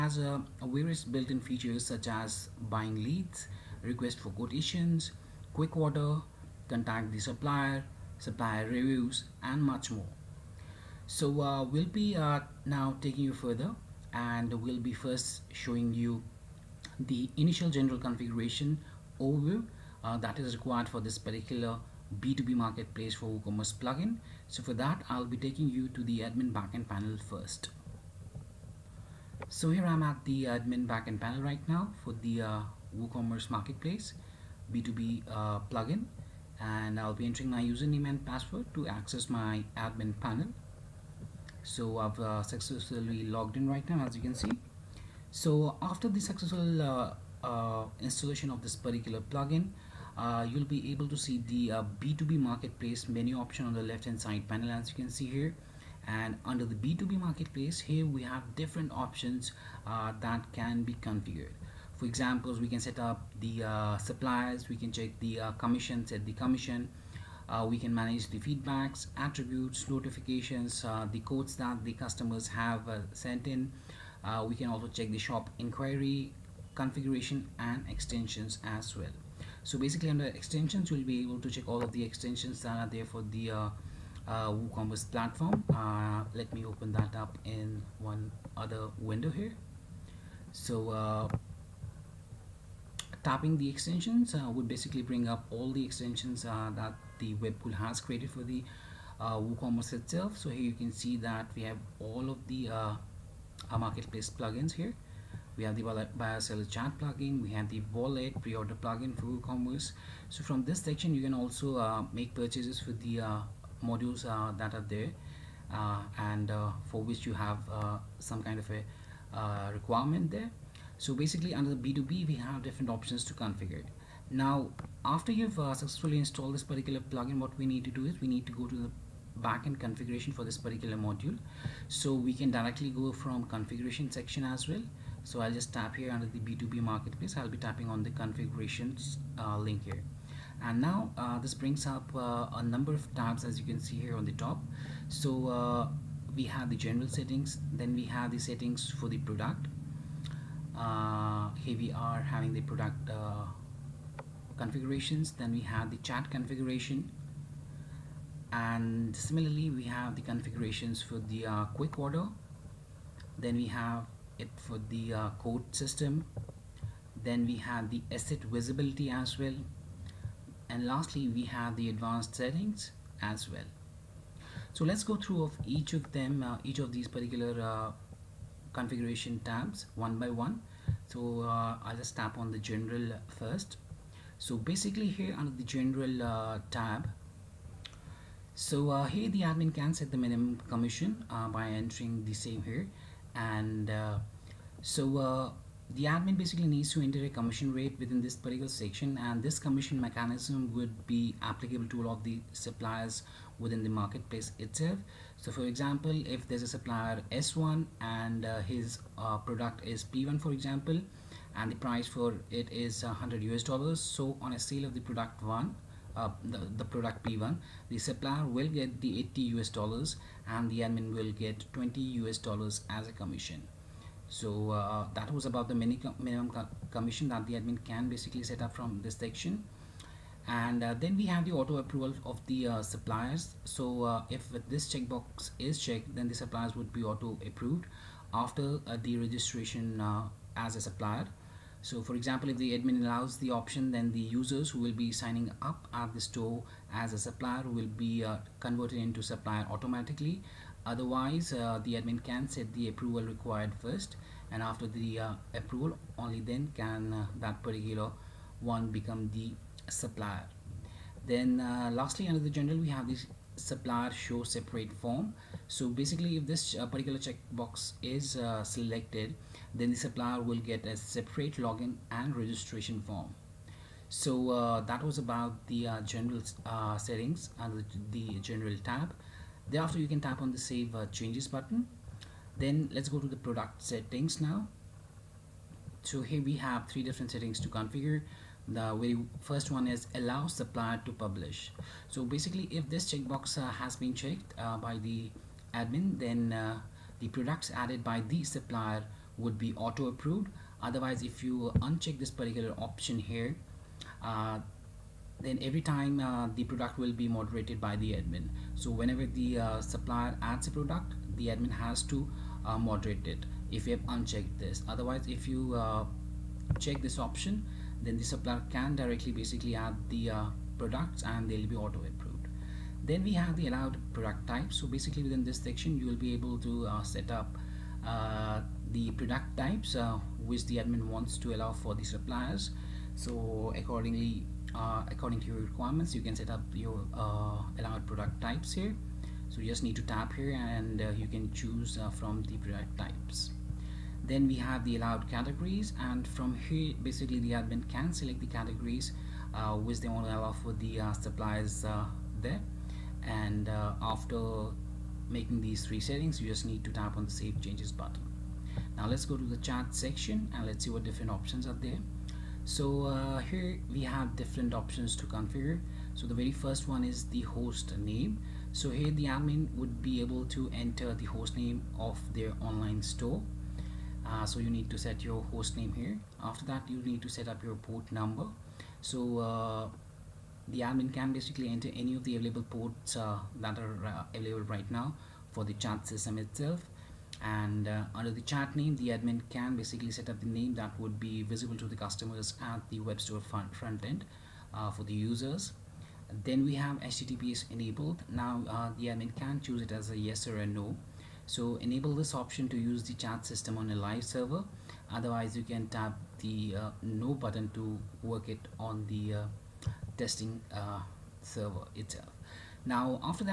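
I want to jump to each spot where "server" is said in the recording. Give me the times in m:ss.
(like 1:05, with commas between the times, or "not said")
6:44, 6:51.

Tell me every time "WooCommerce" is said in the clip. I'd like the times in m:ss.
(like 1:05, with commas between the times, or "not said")
0:23, 0:32, 1:24, 1:39, 1:49.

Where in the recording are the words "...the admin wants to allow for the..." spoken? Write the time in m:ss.
5:30.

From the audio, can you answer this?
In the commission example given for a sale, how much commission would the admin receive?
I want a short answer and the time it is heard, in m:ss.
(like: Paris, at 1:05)
20 US dollars, at 3:41.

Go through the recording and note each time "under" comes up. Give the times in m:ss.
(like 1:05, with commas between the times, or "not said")
0:56, 1:20, 2:01, 2:16, 3:05, 4:22, 4:37, 6:28.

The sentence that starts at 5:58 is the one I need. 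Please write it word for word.
Now let's go to the chat section and let's see what different options are there.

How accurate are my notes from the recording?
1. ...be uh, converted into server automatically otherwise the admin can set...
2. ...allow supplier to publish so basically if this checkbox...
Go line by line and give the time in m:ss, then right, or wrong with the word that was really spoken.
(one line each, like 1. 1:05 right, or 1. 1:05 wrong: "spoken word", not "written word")
1. 4:07 wrong: "supplier", not "server"
2. 4:50 right.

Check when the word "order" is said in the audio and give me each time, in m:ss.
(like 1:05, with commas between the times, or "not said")
0:05, 1:48, 2:41.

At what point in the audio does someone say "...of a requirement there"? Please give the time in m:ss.
1:58.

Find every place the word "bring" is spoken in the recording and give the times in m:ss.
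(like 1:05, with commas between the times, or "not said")
1:35, 2:21.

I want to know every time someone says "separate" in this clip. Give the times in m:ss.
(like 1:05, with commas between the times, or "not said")
4:24, 4:30.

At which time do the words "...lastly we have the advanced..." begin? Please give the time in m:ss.
2:50.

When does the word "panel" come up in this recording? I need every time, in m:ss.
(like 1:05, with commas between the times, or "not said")
0:26, 0:31, 0:40, 0:54.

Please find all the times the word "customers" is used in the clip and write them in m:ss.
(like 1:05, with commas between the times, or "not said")
1:11, 6:31.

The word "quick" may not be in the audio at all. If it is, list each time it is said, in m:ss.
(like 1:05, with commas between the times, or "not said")
0:05, 2:41.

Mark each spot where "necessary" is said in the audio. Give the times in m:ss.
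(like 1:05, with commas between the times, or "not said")
not said.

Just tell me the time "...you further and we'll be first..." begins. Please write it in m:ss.
0:13.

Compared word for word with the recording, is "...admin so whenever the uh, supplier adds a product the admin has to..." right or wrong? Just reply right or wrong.
right.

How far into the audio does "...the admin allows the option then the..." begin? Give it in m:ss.
4:02.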